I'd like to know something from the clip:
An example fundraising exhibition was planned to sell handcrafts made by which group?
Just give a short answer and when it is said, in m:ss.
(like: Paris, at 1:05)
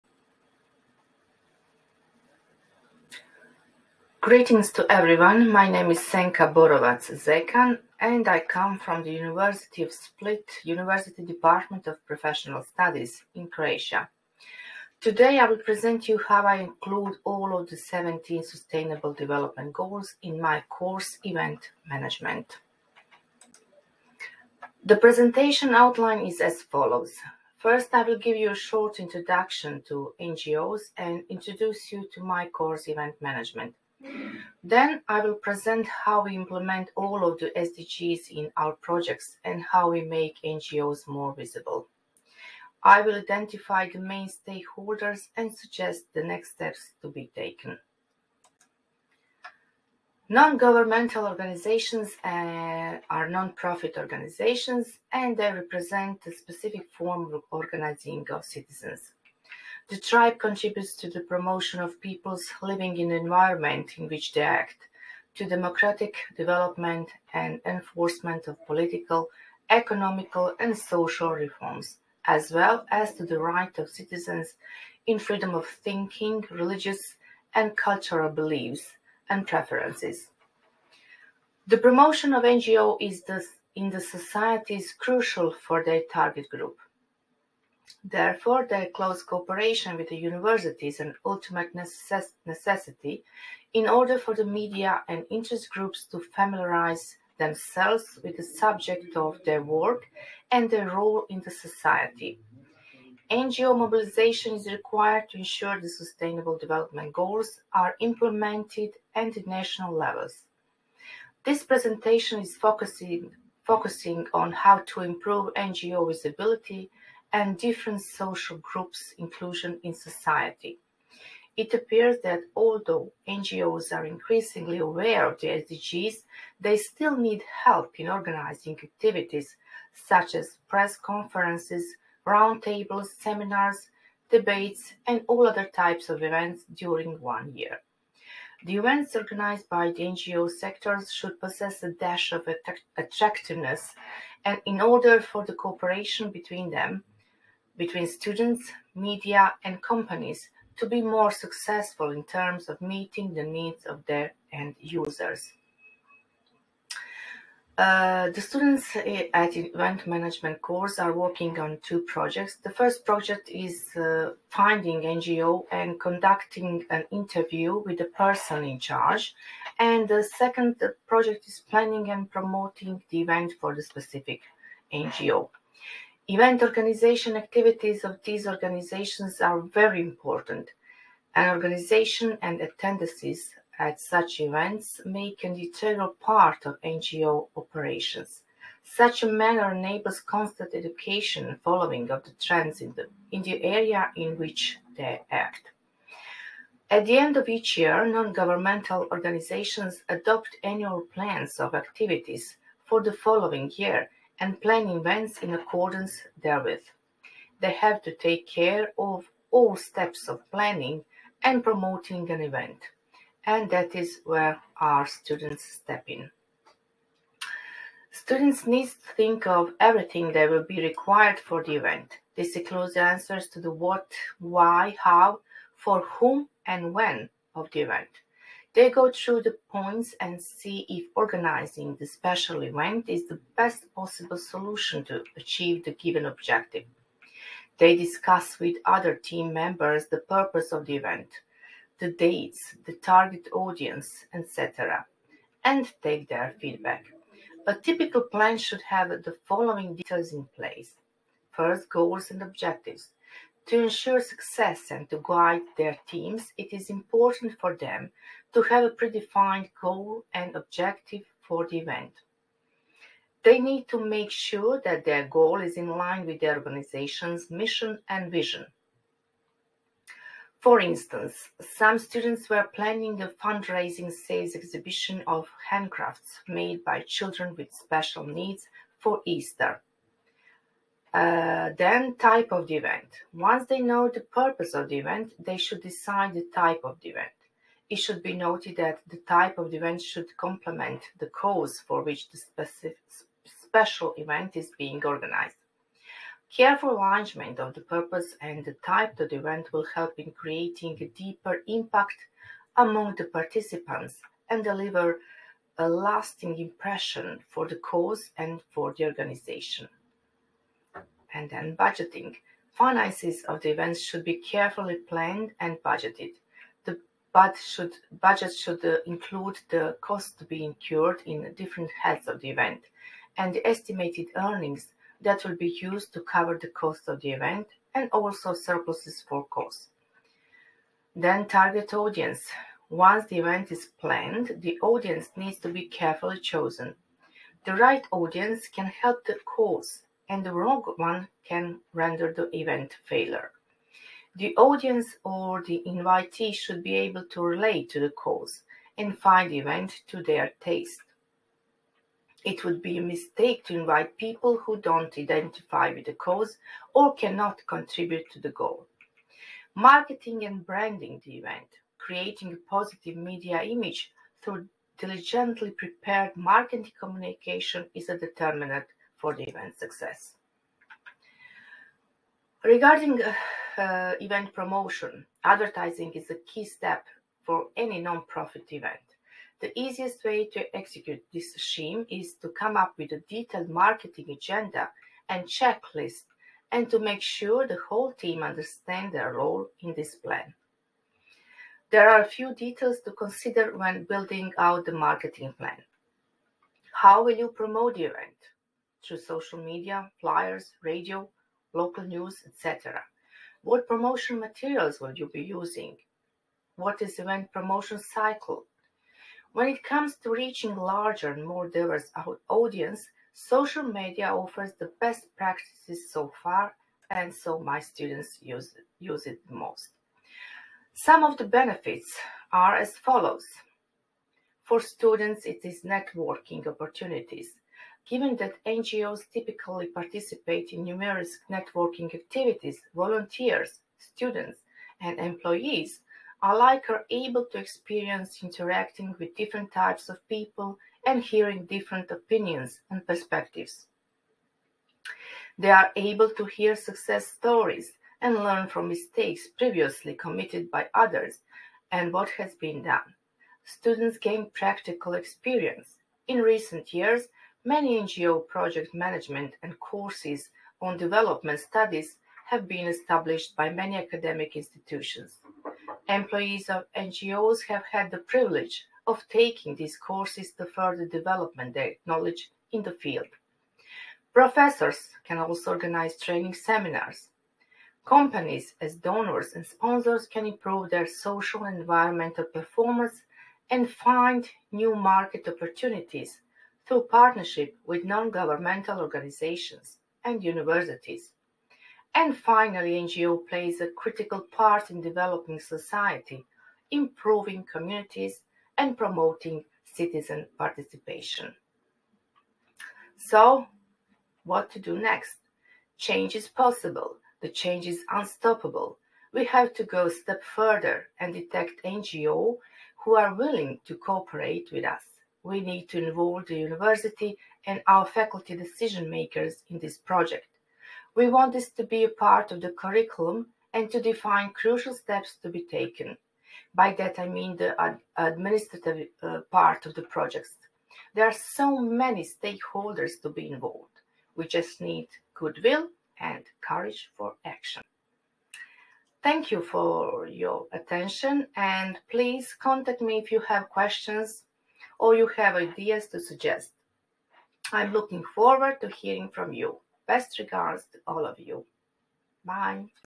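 children with special needs, at 4:37.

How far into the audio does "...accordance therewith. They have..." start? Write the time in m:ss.
3:25.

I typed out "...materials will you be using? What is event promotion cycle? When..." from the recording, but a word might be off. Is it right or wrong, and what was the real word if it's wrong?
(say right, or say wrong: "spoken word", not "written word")
right.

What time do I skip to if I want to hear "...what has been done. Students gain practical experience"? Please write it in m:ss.
7:32.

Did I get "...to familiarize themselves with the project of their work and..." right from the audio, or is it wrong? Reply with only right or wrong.
wrong.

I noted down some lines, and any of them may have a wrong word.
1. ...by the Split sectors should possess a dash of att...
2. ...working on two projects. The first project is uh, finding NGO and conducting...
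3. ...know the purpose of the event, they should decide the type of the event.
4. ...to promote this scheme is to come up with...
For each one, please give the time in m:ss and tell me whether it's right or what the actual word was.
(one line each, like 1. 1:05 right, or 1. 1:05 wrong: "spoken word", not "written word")
1. 2:19 wrong: "NGO", not "Split"
2. 2:41 right
3. 4:43 right
4. 6:20 wrong: "execute", not "promote".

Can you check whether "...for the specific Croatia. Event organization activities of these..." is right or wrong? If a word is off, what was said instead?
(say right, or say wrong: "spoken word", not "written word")
wrong: "NGO", not "Croatia".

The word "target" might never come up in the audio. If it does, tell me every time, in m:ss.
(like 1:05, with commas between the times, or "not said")
1:26, 4:02, 5:31.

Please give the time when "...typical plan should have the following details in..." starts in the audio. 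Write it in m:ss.
4:07.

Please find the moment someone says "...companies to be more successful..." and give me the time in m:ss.
2:29.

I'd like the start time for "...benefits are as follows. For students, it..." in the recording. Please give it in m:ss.
7:01.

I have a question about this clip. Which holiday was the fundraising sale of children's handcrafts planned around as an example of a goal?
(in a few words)
Easter.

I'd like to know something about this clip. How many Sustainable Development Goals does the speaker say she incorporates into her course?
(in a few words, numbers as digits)
17.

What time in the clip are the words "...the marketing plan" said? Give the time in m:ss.
6:34.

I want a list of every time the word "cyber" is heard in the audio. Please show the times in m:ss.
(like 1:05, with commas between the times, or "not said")
not said.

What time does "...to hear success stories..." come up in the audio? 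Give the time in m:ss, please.
7:26.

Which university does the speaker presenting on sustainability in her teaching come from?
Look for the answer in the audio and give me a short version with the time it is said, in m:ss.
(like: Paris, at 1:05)
University of Split, at 0:09.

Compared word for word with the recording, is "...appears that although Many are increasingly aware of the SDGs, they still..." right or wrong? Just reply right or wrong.
wrong.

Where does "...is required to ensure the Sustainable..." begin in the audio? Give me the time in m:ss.
1:44.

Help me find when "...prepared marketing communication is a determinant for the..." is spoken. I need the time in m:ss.
6:05.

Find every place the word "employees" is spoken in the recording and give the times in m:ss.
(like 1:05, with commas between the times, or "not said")
7:15, 7:46.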